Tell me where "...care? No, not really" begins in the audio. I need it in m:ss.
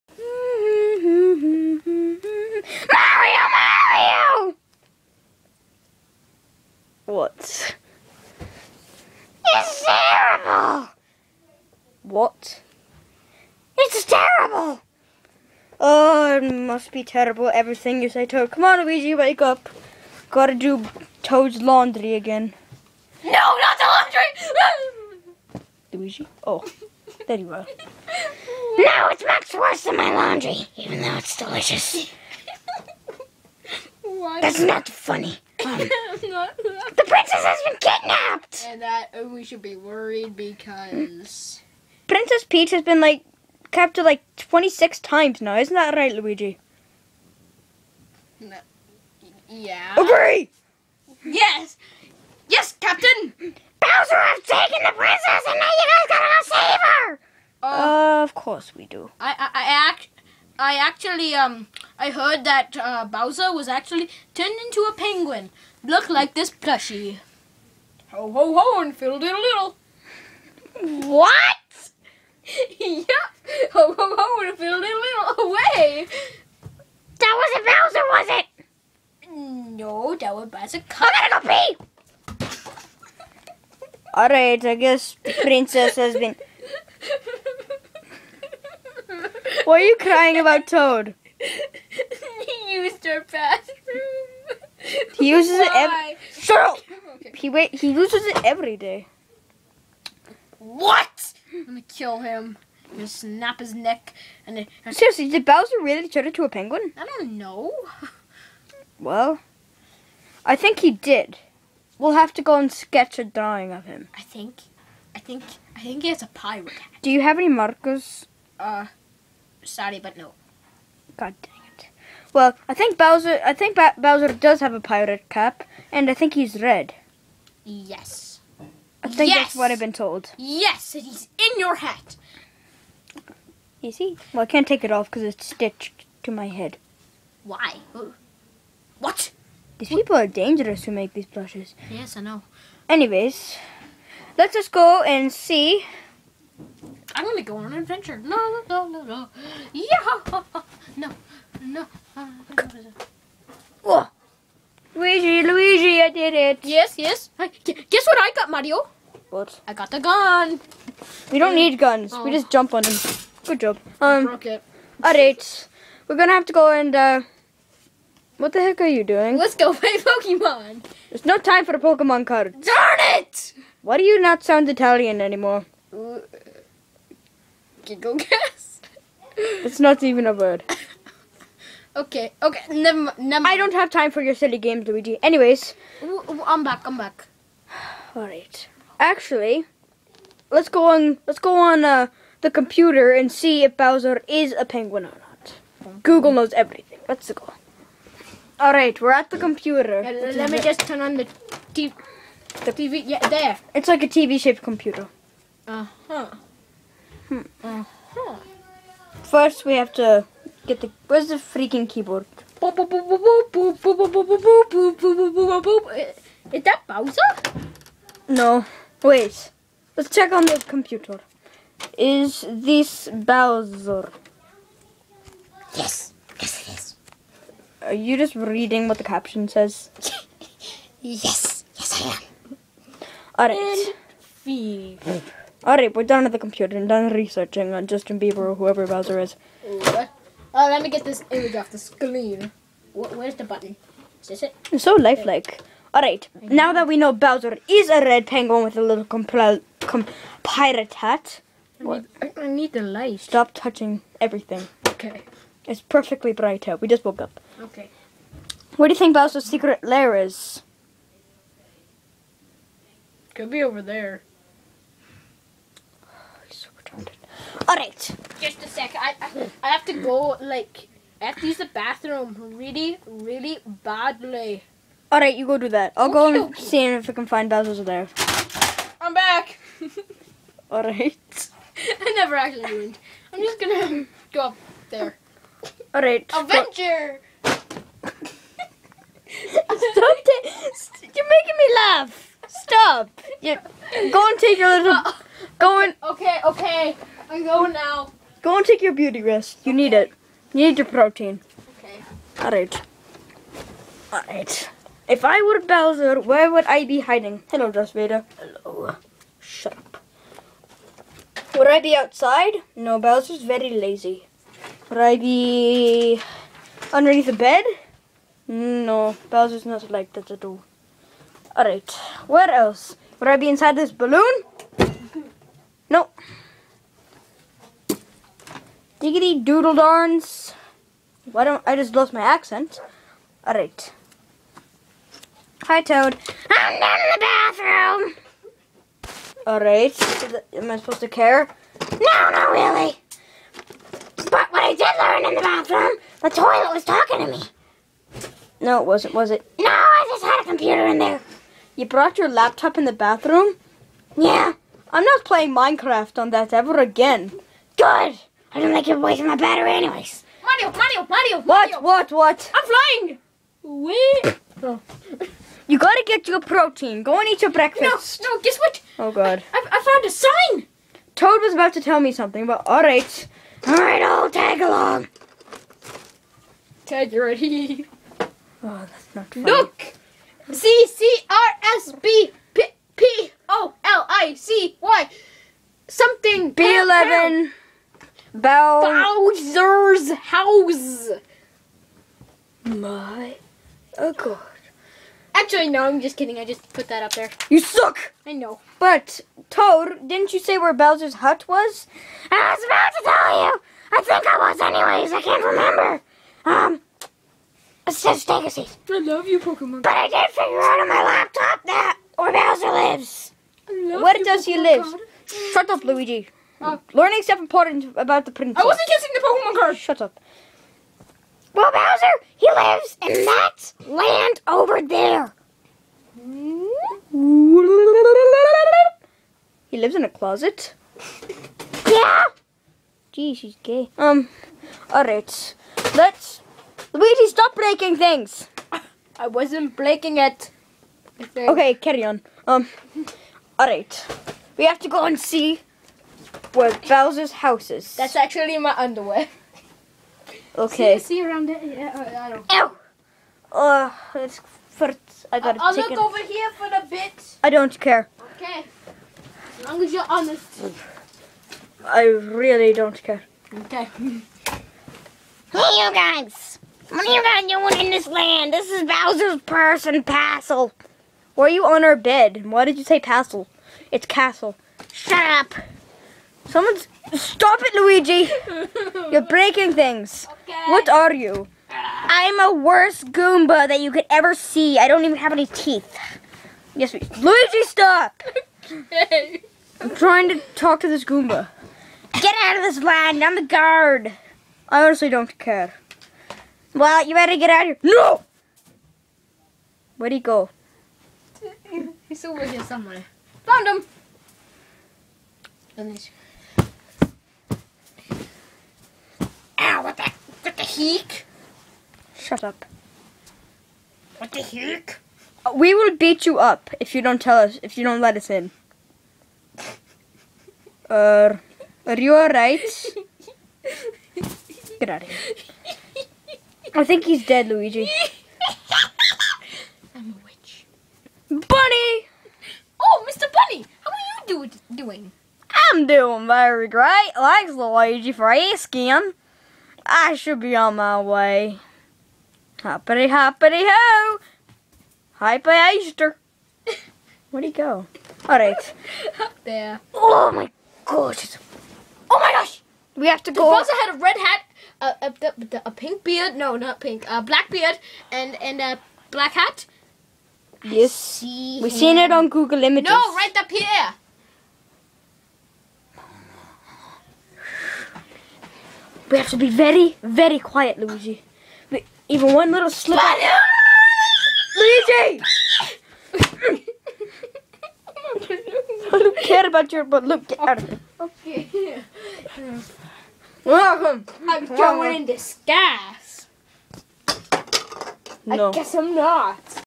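5:41.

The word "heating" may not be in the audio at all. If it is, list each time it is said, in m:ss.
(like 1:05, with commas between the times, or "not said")
not said.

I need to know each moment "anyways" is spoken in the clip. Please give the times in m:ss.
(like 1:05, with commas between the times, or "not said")
2:22, 3:05, 5:59, 6:44.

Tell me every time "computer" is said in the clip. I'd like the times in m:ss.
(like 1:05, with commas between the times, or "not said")
3:12, 3:19, 3:24, 3:40, 3:56, 5:50.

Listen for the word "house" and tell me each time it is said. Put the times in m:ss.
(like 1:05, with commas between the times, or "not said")
6:30, 7:27.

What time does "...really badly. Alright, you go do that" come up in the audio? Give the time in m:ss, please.
4:33.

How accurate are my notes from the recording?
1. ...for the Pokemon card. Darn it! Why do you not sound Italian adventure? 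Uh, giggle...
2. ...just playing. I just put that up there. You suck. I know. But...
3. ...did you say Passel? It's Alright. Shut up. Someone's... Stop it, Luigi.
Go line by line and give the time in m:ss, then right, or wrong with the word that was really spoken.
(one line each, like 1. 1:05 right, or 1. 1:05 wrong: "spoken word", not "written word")
1. 2:51 wrong: "anymore", not "adventure"
2. 6:36 wrong: "kidding", not "playing"
3. 7:52 wrong: "Castle", not "Alright".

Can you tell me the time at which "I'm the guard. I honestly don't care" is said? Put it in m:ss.
8:13.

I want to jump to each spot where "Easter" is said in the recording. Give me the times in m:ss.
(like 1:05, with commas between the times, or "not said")
9:05.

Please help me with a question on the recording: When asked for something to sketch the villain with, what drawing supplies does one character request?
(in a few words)
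Markers.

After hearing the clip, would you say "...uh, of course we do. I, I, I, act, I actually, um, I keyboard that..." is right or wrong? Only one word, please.
wrong.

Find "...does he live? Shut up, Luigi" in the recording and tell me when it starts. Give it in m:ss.
6:54.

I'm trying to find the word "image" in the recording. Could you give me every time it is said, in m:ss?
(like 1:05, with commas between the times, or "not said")
4:01, 9:22.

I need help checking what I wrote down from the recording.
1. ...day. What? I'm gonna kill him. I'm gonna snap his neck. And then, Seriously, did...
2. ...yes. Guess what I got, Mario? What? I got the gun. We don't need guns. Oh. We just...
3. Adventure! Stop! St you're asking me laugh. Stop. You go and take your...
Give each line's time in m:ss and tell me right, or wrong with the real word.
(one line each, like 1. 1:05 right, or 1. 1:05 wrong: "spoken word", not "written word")
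1. 1:38 right
2. 2:36 right
3. 4:46 wrong: "making", not "asking".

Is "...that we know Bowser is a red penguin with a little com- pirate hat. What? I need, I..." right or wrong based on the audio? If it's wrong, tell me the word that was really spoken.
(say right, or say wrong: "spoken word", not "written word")
right.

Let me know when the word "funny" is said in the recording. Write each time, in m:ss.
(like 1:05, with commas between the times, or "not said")
0:34, 6:19.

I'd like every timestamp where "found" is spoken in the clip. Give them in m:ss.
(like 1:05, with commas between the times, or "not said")
6:09, 8:23.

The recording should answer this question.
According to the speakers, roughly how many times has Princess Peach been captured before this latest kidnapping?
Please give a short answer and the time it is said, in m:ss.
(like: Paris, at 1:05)
26, at 0:44.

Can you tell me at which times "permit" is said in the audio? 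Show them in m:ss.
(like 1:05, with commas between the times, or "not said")
not said.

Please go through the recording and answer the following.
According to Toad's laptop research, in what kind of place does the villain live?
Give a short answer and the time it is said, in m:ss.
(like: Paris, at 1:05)
A closet, at 7:10.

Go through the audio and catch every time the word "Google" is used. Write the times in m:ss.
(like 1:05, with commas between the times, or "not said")
3:16, 9:22.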